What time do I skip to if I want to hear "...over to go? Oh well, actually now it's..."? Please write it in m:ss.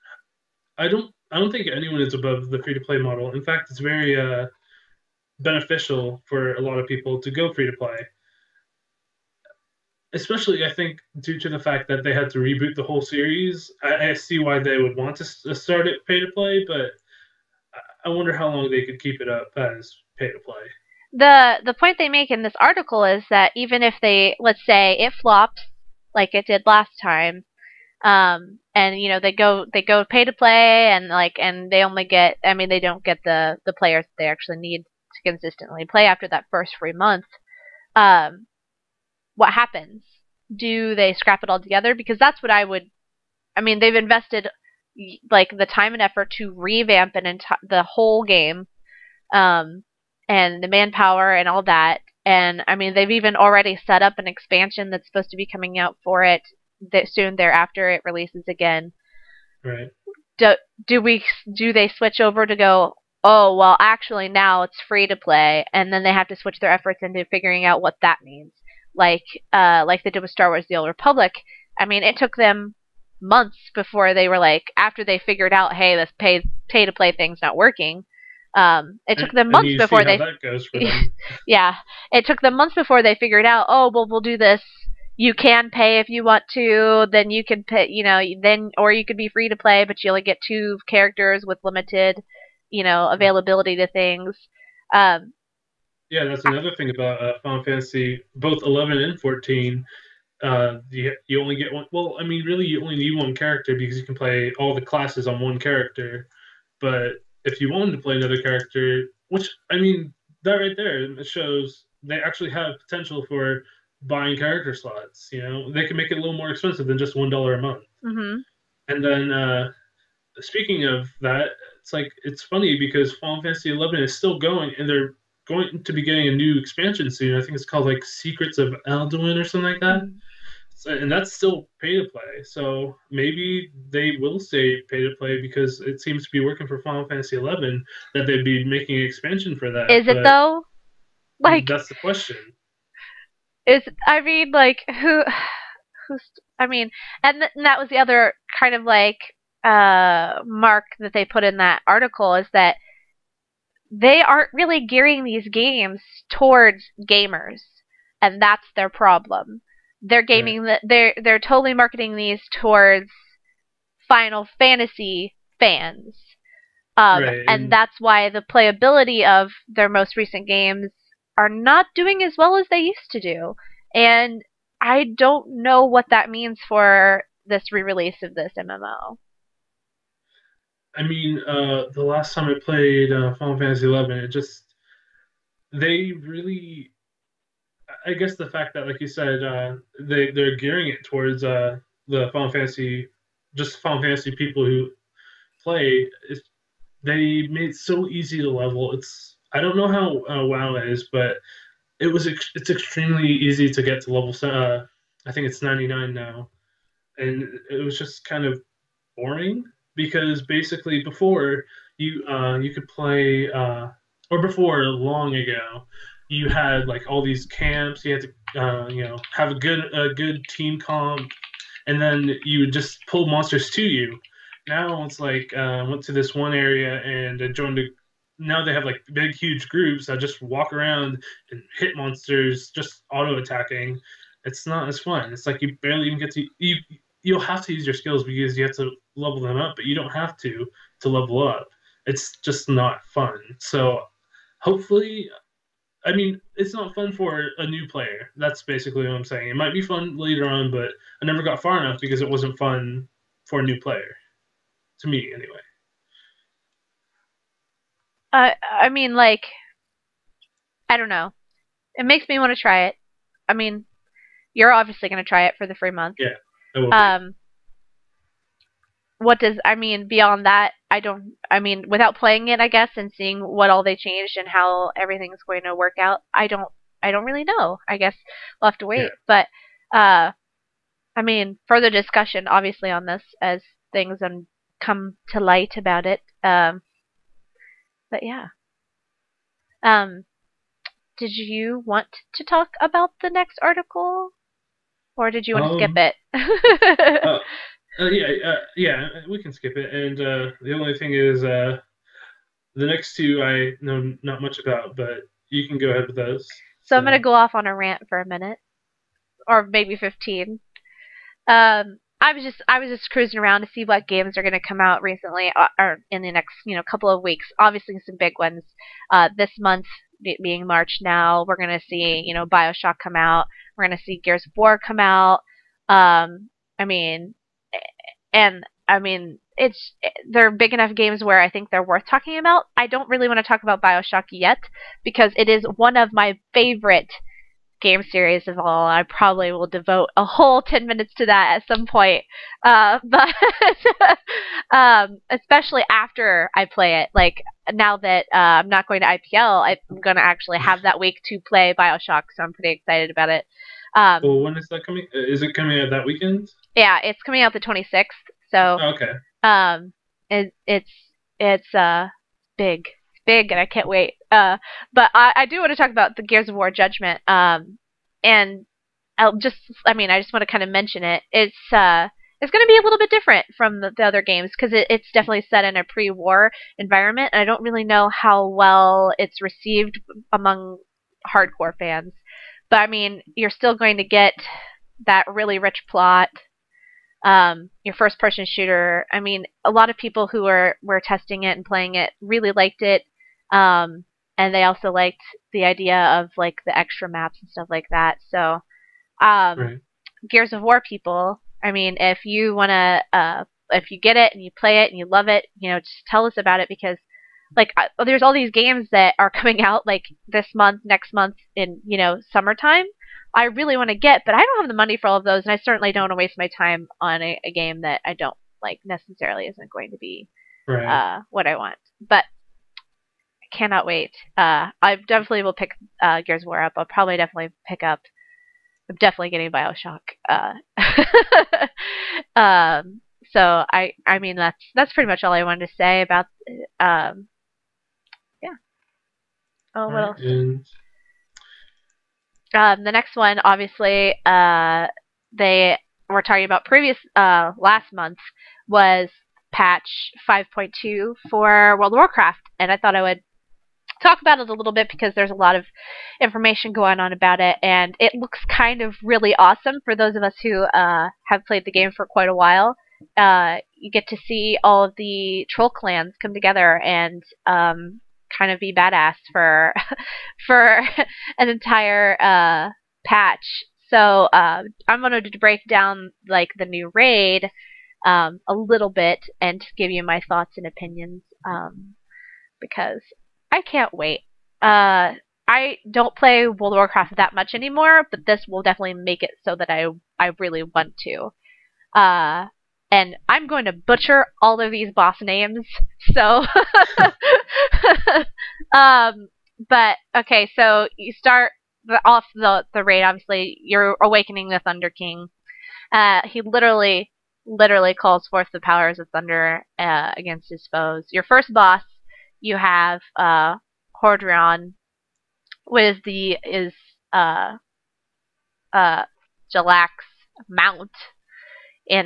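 1:02.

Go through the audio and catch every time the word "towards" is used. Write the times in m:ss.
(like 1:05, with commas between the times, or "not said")
2:36, 2:42, 3:11.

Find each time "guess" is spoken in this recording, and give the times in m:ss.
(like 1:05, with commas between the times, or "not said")
3:08, 4:32, 4:37.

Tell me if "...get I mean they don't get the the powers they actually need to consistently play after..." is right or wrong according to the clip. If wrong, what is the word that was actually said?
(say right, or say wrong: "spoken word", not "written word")
wrong: "players", not "powers".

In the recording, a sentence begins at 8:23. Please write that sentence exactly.
Obviously, you're awakening the Thunder King.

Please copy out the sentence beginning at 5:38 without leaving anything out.
I probably will devote a whole 10 minutes to that at some point.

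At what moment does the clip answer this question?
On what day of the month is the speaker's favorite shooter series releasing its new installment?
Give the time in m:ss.
5:57.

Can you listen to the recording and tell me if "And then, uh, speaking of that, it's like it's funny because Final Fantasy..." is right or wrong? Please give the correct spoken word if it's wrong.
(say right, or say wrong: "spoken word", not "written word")
right.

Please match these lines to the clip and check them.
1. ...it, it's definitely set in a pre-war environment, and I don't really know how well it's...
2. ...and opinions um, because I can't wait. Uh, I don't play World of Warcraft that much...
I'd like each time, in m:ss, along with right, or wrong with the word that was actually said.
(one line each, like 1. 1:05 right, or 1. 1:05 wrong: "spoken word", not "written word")
1. 6:14 right
2. 8:00 right.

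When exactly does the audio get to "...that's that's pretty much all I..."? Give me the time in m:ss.
7:14.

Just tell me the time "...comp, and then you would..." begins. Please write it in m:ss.
3:40.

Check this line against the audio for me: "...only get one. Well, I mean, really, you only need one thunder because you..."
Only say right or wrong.
wrong.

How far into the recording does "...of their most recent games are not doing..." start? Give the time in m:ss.
2:49.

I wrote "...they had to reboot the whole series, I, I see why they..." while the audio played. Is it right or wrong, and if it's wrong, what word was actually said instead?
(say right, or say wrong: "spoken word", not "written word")
right.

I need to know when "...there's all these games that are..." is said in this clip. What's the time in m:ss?
6:48.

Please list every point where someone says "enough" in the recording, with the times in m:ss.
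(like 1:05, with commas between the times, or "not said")
4:11, 5:30.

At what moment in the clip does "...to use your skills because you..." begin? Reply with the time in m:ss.
3:57.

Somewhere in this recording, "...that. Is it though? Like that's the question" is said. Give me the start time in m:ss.
2:19.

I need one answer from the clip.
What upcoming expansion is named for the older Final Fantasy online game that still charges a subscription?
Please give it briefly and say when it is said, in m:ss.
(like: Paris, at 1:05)
Secrets of Adoulin, at 2:08.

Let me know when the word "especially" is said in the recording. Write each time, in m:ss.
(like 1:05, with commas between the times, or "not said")
0:10, 5:45.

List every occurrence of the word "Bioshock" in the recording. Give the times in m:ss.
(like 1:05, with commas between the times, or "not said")
5:22, 5:33, 5:51, 7:09.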